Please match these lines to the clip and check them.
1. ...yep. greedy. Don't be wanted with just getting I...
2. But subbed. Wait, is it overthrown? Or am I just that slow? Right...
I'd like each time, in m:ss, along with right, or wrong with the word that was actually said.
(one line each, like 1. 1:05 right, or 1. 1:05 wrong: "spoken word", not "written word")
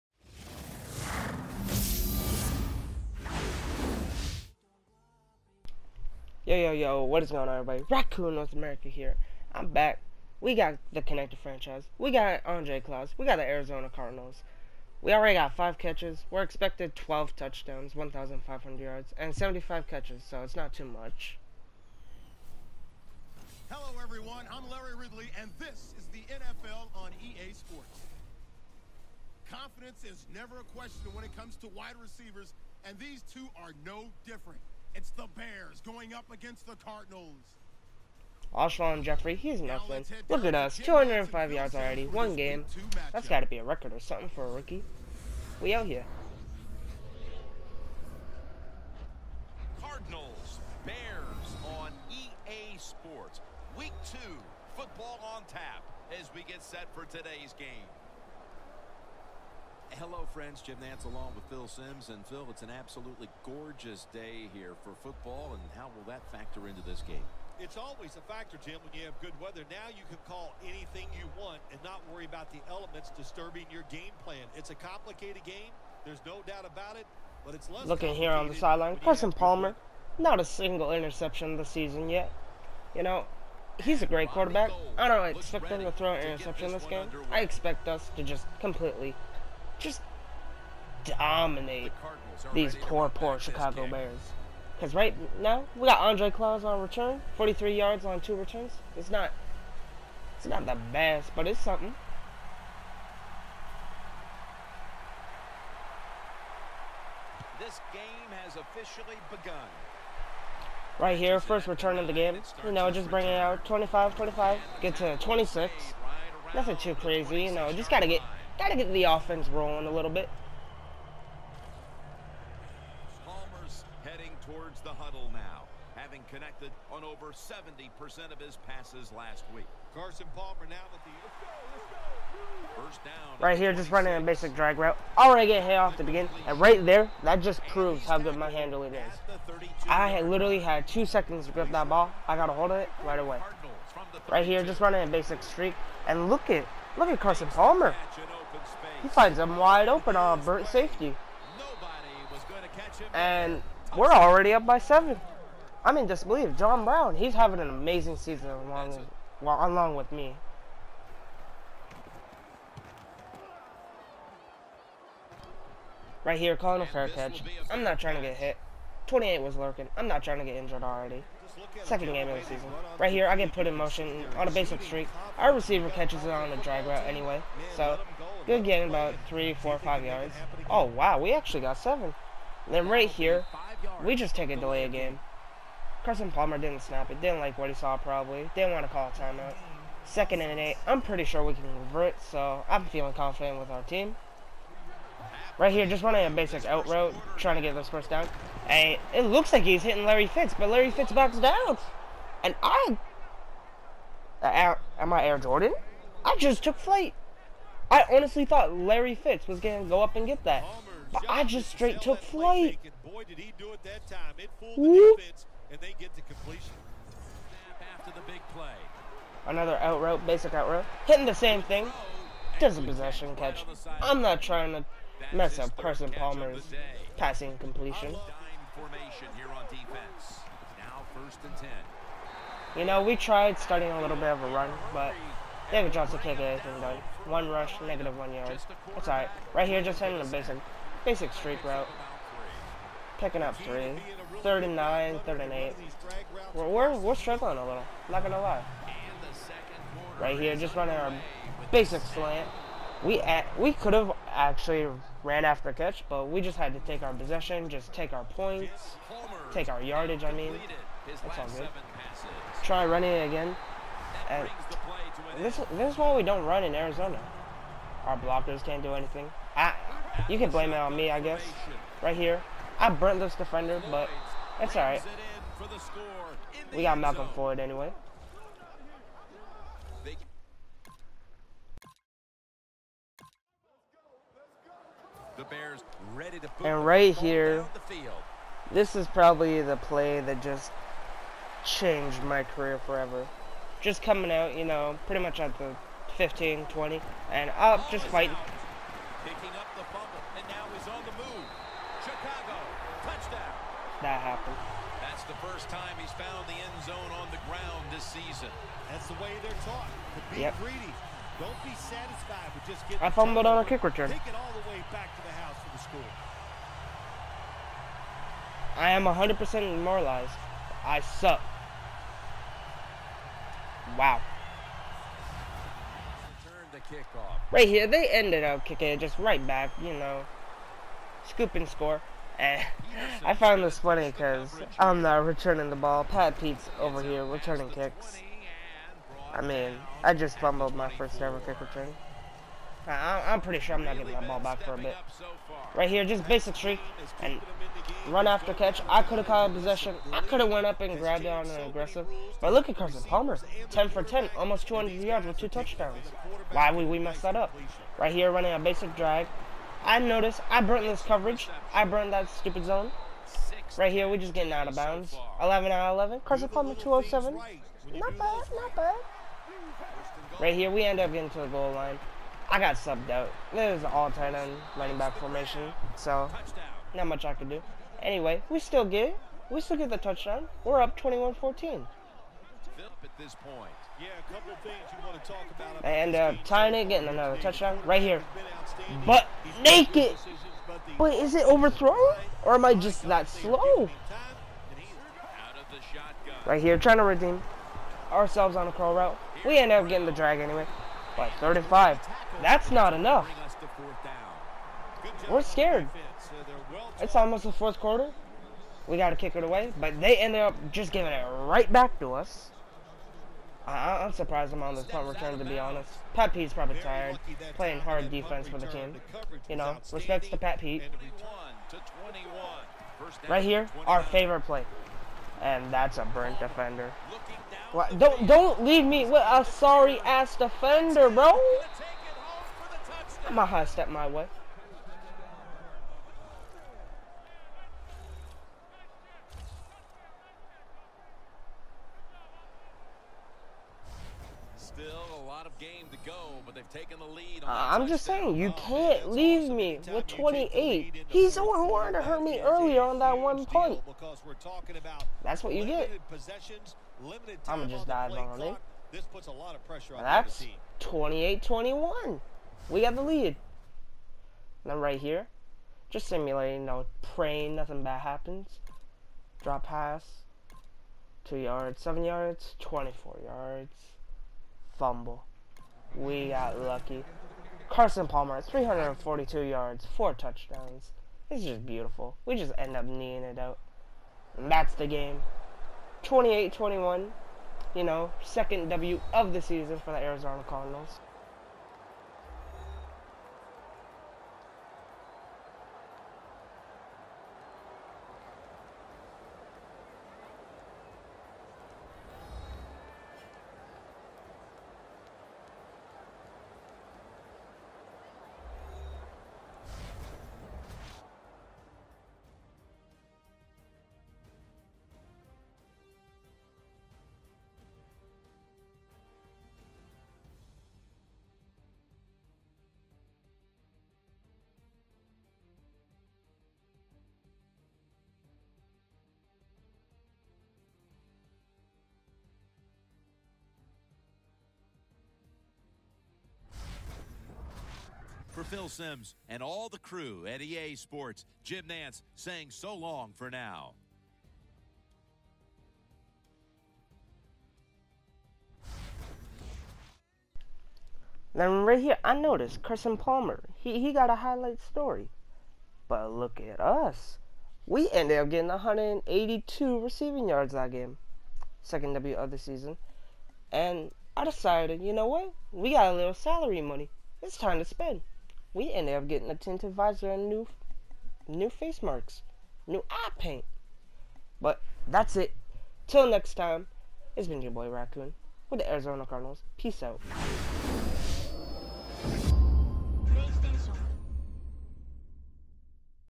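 1. 5:10 wrong: "satisfied", not "wanted"
2. 6:29 wrong: "naked", not "subbed".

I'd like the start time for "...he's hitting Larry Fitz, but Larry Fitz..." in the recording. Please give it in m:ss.
3:19.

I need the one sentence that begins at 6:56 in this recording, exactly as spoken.
Pat Pete's probably tired, playing hard defense for the team.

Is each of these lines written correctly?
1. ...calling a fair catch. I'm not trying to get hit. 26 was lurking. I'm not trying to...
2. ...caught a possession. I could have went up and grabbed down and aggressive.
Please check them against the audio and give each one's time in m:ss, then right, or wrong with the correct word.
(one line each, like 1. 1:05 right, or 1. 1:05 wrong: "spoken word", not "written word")
1. 2:46 wrong: "28", not "26"
2. 5:49 right.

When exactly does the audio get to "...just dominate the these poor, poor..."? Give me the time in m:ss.
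1:29.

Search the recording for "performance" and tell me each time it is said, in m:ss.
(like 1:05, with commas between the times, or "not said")
not said.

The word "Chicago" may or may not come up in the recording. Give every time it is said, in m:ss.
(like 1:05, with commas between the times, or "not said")
1:33, 5:02.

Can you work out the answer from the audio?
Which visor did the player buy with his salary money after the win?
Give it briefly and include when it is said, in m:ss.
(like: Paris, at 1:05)
tinted visor, at 9:29.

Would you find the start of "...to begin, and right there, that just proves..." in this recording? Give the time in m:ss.
2:15.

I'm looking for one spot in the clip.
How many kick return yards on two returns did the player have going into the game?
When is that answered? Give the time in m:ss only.
1:37.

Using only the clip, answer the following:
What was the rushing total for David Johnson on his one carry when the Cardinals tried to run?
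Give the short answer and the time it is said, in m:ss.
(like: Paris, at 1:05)
-1 yard, at 3:57.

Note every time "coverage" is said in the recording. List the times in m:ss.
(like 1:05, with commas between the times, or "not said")
6:01.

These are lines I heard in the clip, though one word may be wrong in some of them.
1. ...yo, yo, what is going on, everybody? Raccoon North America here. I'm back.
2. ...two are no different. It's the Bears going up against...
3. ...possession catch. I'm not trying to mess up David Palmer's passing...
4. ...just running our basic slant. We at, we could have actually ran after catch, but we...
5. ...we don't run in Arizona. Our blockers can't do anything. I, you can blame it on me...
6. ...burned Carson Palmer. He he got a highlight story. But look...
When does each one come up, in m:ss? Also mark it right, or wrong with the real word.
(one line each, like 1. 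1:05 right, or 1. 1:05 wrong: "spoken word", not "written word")
1. 0:06 right
2. 0:33 right
3. 3:42 wrong: "Carson", not "David"
4. 4:10 right
5. 4:26 right
6. 9:12 wrong: "noticed", not "burned".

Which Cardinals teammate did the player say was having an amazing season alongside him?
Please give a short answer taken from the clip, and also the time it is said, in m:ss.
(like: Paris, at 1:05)
John Brown, at 2:36.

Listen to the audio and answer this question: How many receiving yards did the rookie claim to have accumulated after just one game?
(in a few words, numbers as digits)
205.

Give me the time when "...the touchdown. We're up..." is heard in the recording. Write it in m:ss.
6:19.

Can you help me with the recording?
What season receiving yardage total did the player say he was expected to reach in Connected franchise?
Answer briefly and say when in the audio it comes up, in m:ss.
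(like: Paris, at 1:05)
1,500 yards, at 0:17.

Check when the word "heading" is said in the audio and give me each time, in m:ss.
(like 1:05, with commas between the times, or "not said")
2:04.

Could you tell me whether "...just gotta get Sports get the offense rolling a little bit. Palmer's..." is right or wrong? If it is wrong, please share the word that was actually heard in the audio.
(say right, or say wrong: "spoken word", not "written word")
wrong: "Gotta", not "Sports".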